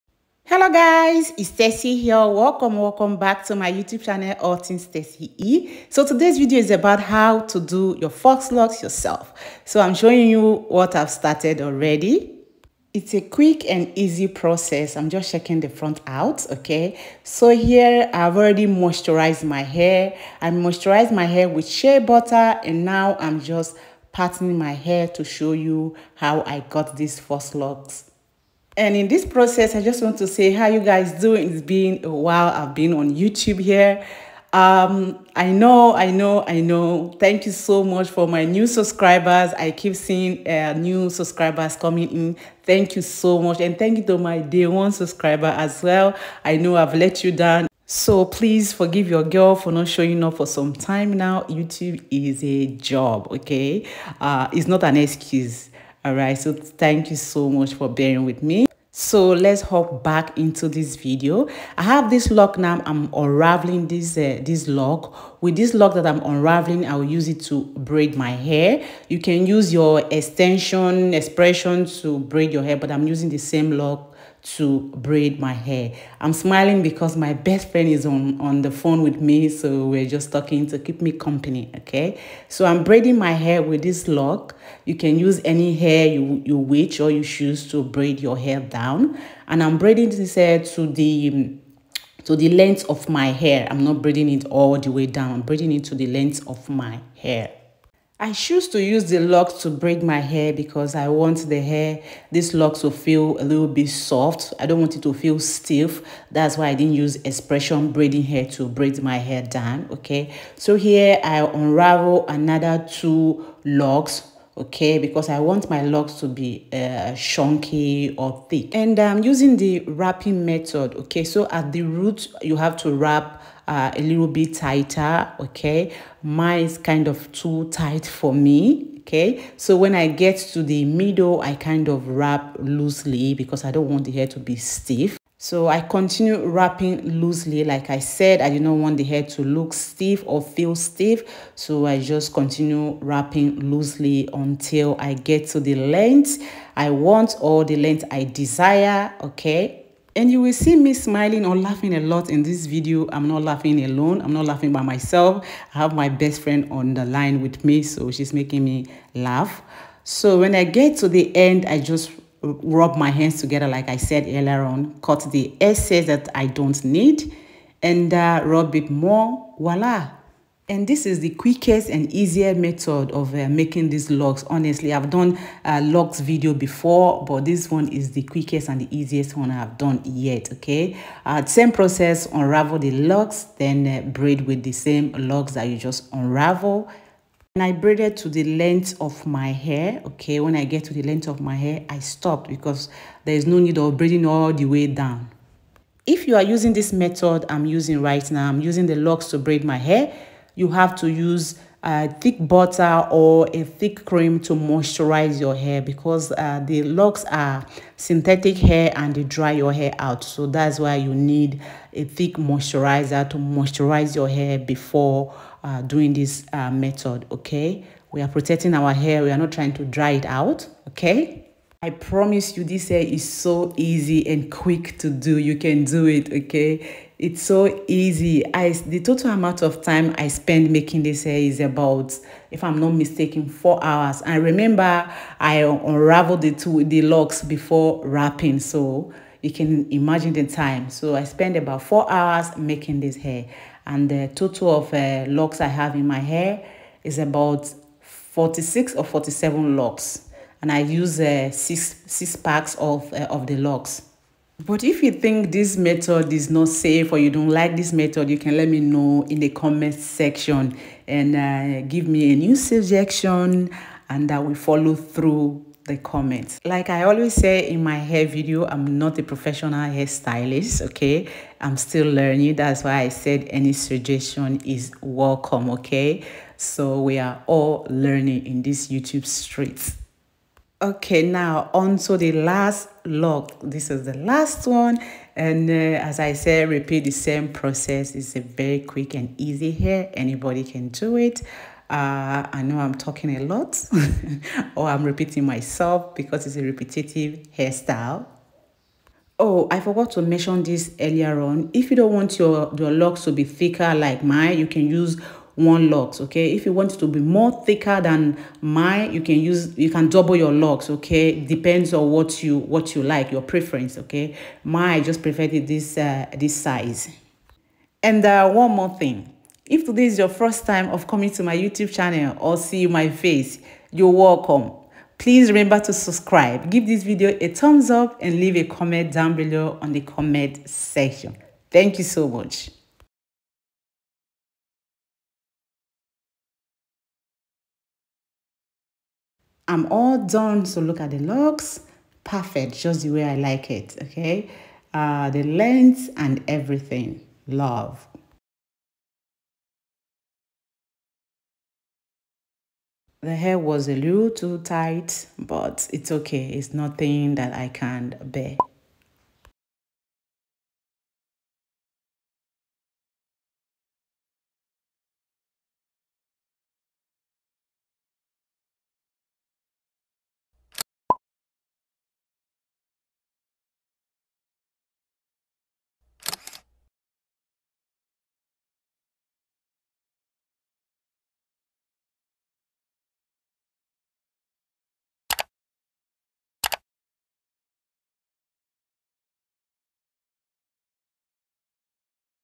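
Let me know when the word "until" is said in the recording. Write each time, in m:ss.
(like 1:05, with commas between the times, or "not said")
2:24.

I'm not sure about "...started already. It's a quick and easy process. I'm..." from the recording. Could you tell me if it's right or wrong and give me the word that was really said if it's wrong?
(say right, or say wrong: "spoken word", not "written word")
right.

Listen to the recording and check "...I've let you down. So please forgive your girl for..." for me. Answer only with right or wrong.
right.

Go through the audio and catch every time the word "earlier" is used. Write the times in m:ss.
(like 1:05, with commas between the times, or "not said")
2:44, 5:01.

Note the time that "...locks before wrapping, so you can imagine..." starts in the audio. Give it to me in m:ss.
3:57.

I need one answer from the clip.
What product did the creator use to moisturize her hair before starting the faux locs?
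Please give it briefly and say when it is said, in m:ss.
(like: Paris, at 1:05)
shea butter, at 0:21.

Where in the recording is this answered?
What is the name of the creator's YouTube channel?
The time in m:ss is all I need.
0:04.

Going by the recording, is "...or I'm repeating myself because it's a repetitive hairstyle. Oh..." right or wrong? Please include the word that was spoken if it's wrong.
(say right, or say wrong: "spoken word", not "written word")
right.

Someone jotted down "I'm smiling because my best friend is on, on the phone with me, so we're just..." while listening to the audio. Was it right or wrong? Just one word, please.
right.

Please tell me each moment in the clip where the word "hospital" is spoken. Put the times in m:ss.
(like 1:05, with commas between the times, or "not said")
not said.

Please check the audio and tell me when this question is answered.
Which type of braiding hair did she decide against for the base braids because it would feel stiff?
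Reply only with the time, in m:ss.
1:47.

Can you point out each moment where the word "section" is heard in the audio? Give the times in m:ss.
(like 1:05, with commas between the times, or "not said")
4:19, 5:30.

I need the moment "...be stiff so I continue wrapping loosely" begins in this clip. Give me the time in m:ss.
2:14.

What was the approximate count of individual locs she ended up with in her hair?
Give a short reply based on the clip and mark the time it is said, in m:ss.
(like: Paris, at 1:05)
46 or 47, at 4:08.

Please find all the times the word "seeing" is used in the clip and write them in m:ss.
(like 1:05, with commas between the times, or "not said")
0:39.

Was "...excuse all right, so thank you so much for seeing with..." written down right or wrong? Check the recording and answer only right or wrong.
wrong.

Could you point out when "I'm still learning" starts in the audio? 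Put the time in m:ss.
4:31.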